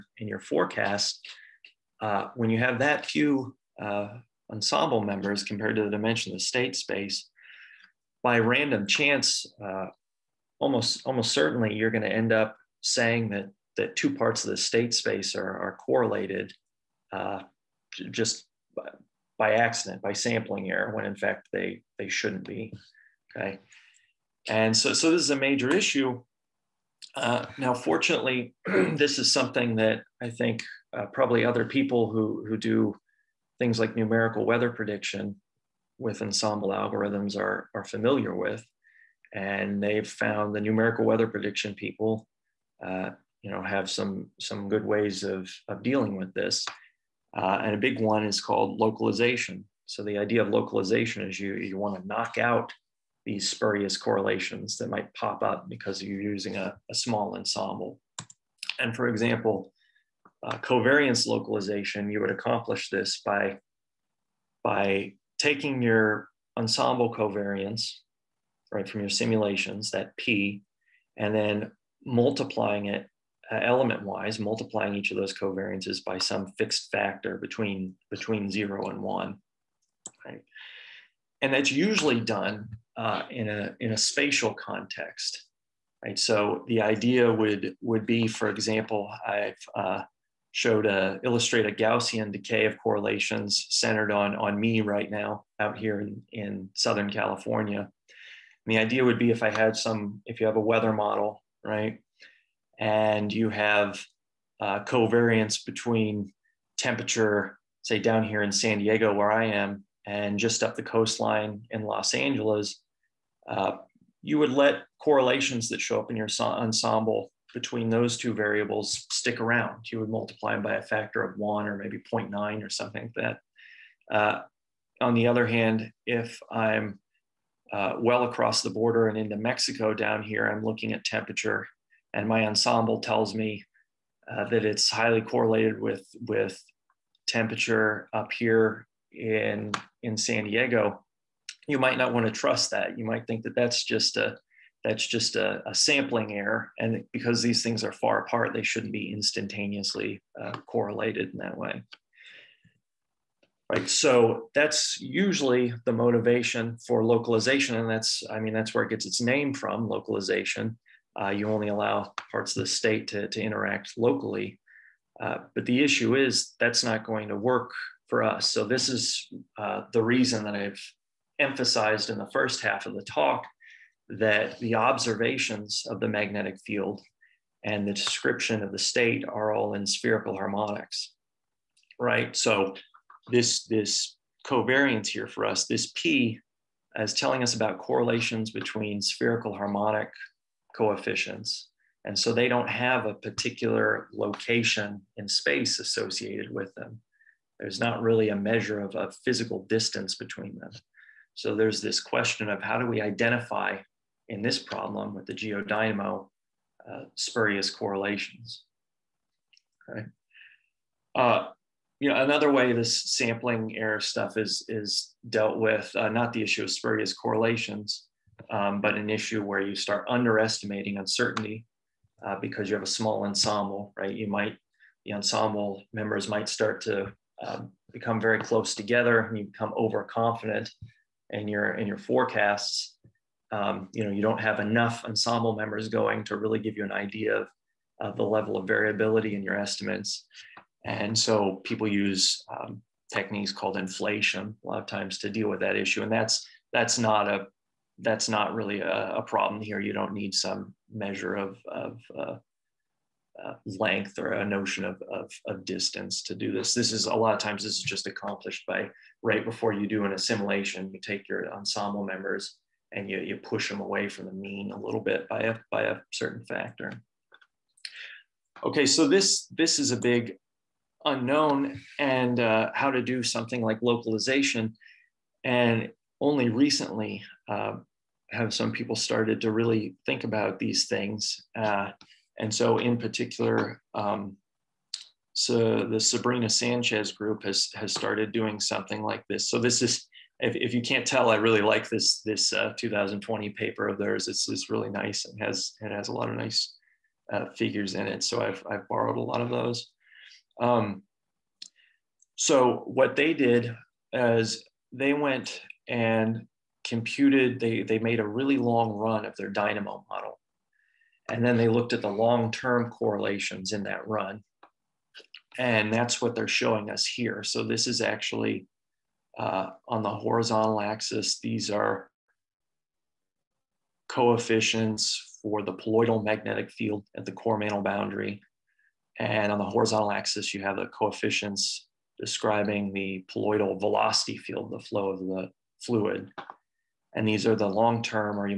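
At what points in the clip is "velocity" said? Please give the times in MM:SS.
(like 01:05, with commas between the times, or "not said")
05:33.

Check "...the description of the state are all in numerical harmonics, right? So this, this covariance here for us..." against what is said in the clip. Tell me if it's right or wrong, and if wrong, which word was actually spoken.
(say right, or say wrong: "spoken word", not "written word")
wrong: "spherical", not "numerical".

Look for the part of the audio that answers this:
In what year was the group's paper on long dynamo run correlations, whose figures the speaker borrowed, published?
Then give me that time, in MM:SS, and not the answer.
04:52.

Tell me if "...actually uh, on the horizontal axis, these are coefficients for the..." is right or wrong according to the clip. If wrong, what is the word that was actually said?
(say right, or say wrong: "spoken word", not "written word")
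right.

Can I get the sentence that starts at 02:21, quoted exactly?
You might not want to trust that.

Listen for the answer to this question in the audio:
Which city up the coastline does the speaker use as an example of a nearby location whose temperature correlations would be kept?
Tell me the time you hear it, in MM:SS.
01:51.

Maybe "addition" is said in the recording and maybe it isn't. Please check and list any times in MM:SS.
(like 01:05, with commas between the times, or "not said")
not said.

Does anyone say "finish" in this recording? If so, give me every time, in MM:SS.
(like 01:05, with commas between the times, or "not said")
not said.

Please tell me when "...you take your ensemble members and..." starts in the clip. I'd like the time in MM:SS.
04:20.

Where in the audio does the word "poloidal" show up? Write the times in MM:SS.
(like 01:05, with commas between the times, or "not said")
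05:25, 05:33.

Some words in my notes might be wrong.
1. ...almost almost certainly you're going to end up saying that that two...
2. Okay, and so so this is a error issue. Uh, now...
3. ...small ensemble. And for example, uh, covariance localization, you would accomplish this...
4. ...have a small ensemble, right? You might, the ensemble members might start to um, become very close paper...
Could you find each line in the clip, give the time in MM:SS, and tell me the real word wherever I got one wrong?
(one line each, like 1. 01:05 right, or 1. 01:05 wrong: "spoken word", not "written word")
1. 00:10 right
2. 00:23 wrong: "major", not "error"
3. 00:56 right
4. 03:42 wrong: "together", not "paper".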